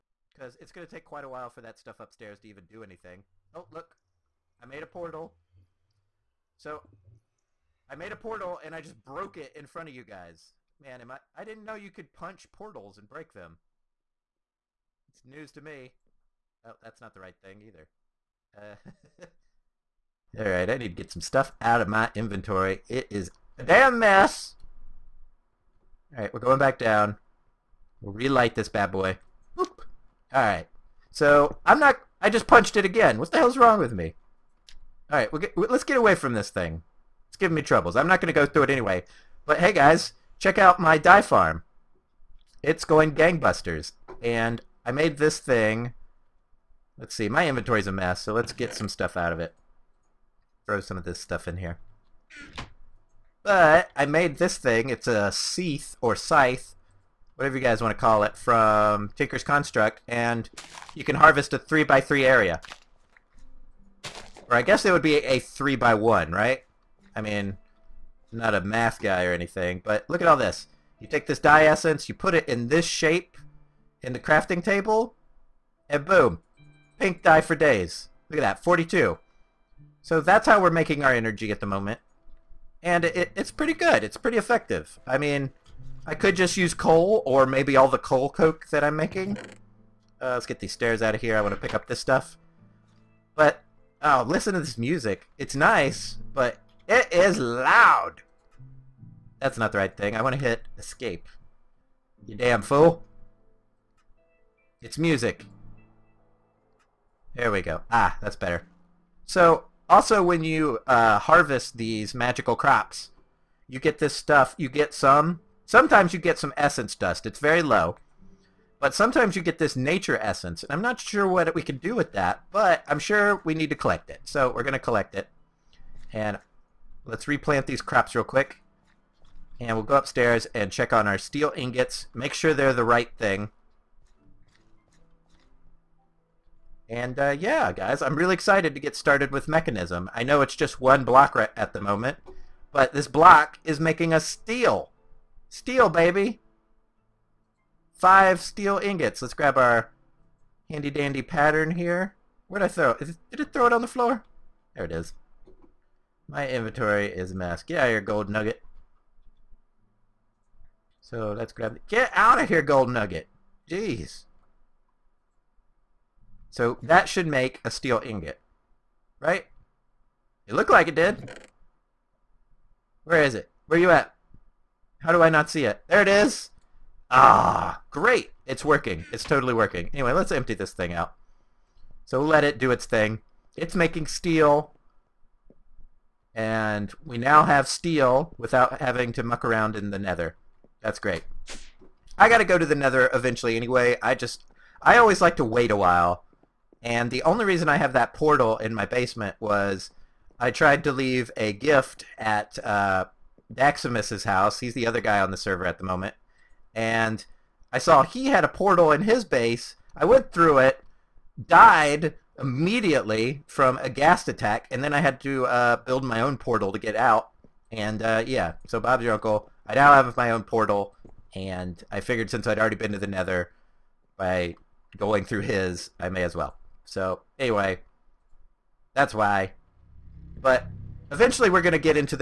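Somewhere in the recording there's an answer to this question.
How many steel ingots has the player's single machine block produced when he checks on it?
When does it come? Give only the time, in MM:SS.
02:27.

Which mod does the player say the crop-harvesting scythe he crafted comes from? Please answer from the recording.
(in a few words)
Tinker's Construct.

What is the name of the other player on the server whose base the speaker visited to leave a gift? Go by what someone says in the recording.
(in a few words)
Daximus.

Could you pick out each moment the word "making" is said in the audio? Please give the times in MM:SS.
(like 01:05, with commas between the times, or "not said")
01:20, 01:28, 02:23, 03:03.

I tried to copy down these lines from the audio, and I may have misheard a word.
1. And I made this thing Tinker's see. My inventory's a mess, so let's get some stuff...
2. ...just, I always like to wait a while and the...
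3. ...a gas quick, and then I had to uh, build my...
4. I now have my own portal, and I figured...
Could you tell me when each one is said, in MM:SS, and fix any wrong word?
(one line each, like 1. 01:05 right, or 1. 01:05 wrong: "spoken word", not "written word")
1. 00:44 wrong: "Let", not "Tinker"
2. 03:14 right
3. 03:33 wrong: "attack", not "quick"
4. 03:39 right.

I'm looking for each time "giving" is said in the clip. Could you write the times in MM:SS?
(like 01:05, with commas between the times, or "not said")
00:37.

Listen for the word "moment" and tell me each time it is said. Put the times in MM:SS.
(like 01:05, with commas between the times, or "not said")
01:21, 02:21, 03:25.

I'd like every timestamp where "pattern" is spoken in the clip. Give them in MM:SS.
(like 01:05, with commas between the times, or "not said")
02:31.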